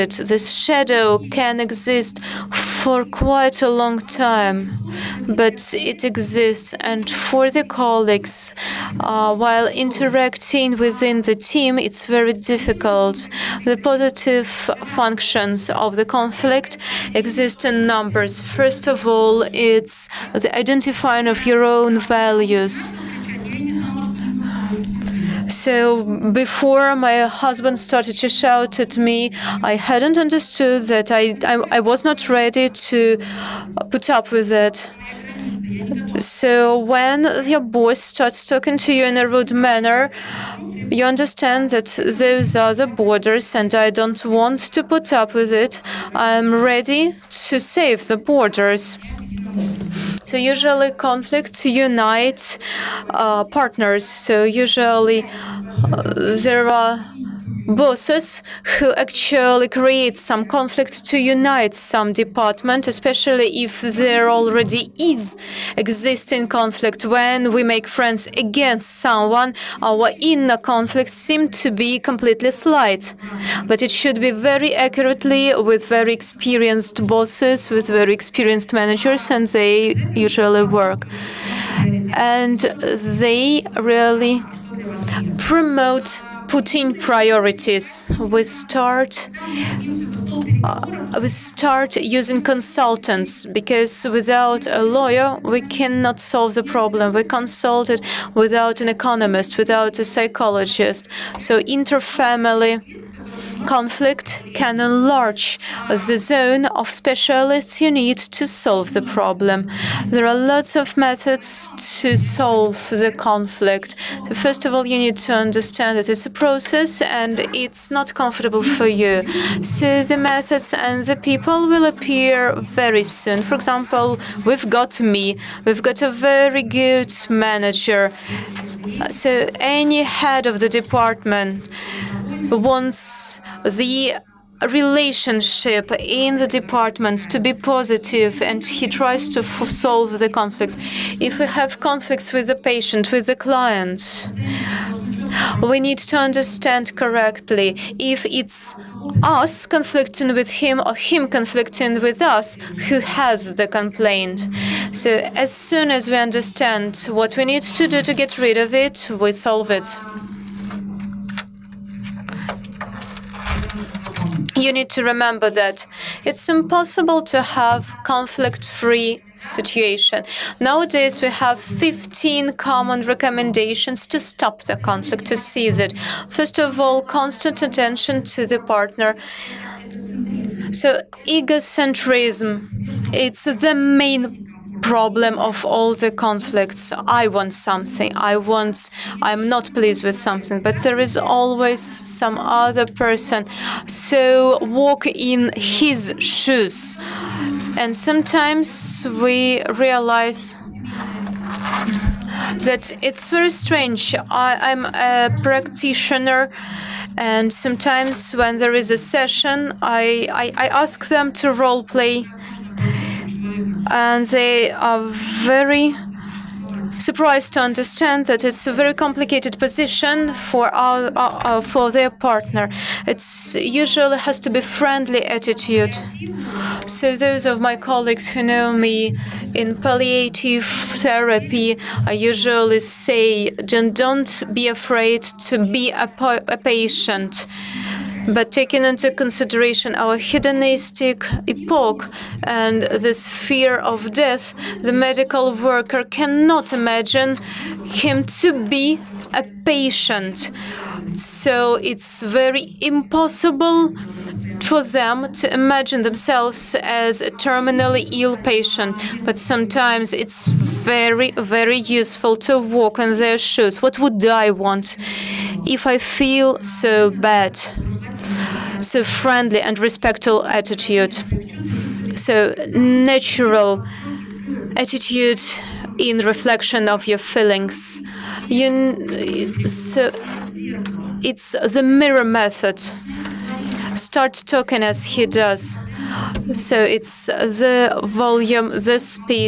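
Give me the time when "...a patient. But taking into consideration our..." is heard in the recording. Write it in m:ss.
3:56.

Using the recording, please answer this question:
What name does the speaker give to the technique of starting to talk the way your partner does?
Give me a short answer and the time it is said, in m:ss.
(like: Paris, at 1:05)
The mirror method, at 4:41.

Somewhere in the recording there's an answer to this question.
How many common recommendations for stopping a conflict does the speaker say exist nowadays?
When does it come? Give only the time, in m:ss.
2:51.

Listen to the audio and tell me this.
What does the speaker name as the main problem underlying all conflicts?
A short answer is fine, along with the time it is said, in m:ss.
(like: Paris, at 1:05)
Egocentrism, at 3:01.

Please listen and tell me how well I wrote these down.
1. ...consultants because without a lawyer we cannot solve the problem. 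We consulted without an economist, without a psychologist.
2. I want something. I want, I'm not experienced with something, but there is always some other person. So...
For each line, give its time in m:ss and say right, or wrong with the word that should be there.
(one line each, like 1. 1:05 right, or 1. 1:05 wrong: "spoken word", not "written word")
1. 1:32 right
2. 3:07 wrong: "pleased", not "experienced".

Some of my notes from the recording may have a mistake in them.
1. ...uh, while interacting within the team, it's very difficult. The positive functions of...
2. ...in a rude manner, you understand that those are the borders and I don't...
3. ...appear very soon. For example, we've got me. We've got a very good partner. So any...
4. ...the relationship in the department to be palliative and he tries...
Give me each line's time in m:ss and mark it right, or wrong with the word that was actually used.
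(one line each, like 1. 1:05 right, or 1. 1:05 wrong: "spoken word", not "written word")
1. 0:08 right
2. 0:39 right
3. 2:01 wrong: "manager", not "partner"
4. 2:13 wrong: "positive", not "palliative".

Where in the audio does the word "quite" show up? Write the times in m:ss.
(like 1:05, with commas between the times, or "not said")
0:03.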